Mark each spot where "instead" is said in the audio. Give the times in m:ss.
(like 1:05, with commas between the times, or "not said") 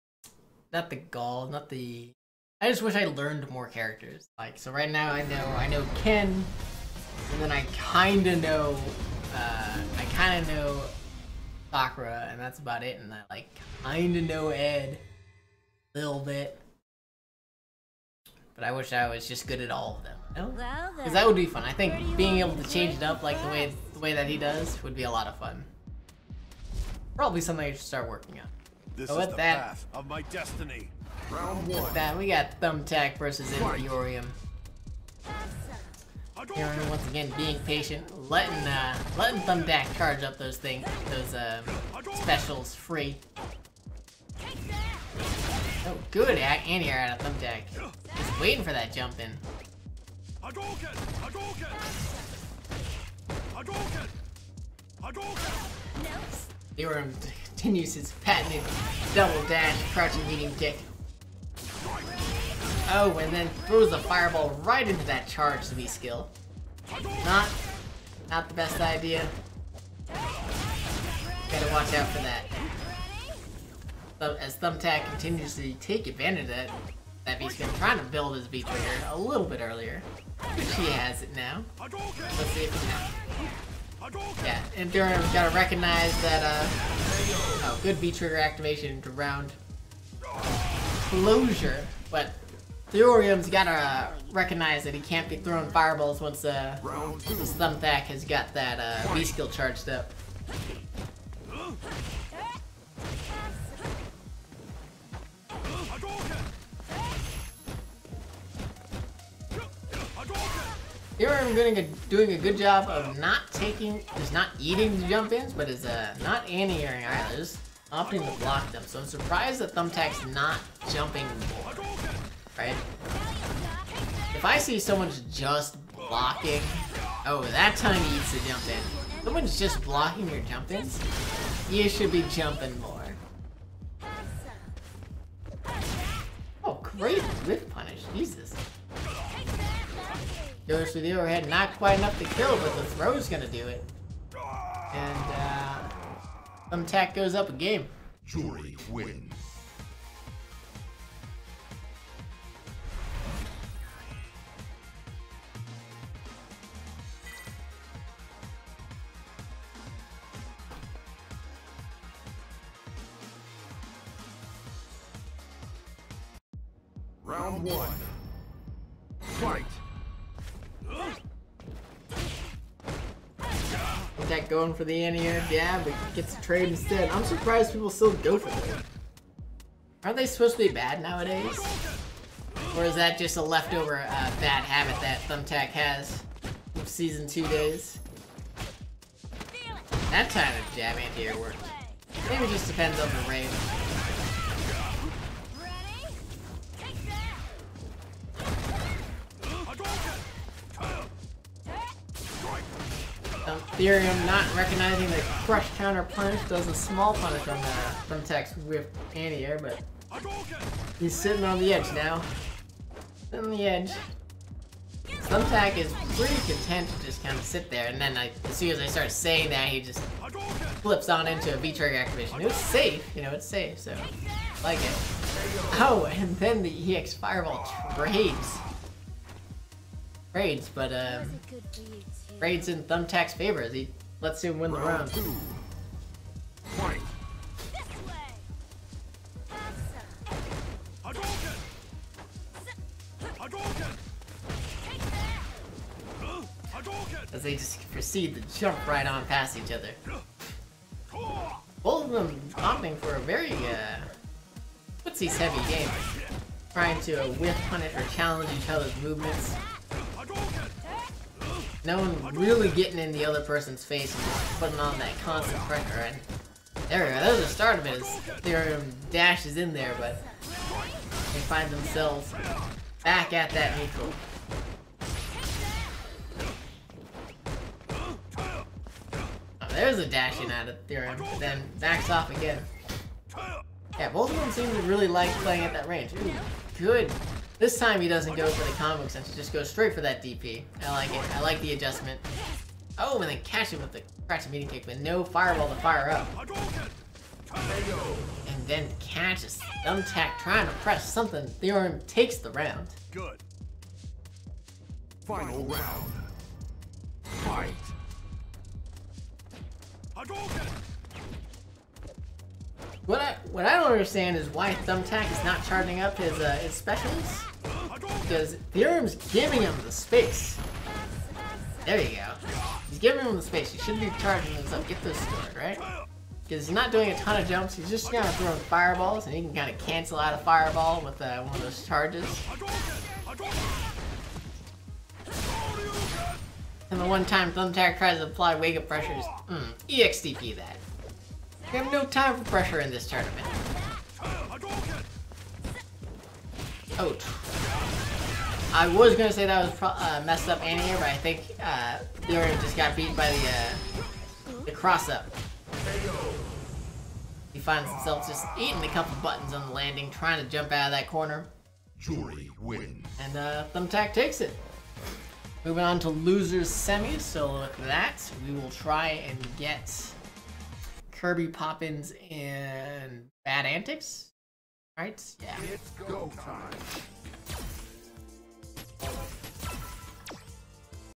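2:56.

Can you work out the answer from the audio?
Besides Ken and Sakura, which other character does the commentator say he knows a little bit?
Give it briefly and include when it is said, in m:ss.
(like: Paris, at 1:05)
Ed, at 0:14.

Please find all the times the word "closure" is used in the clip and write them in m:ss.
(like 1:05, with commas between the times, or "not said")
1:30.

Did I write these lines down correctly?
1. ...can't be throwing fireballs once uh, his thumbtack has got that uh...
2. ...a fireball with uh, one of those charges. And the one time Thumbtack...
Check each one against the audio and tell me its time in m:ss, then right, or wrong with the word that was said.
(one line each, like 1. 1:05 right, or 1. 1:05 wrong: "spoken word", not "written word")
1. 1:35 right
2. 5:30 right.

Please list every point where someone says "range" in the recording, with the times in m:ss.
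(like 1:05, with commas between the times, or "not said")
3:13, 4:45.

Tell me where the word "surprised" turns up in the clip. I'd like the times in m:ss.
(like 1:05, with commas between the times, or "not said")
1:59, 2:57.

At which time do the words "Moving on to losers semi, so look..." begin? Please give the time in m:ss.
6:05.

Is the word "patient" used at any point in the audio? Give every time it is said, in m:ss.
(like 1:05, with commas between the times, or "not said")
0:37.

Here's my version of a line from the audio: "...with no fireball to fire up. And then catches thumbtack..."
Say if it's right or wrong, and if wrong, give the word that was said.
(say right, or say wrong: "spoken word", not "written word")
right.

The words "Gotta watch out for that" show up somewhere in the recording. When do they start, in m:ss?
1:10.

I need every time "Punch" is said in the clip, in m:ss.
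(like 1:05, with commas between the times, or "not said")
3:26.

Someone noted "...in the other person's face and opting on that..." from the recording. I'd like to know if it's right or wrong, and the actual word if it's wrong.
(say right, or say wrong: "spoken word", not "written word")
wrong: "putting", not "opting".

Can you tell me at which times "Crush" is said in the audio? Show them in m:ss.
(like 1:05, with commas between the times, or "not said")
3:25.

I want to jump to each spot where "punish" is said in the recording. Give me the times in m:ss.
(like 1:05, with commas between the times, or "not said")
2:17, 3:27, 4:17.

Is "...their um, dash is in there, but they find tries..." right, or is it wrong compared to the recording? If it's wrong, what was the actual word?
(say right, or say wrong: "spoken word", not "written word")
wrong: "themselves", not "tries".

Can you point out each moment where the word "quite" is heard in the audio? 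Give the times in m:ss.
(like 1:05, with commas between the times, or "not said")
2:21.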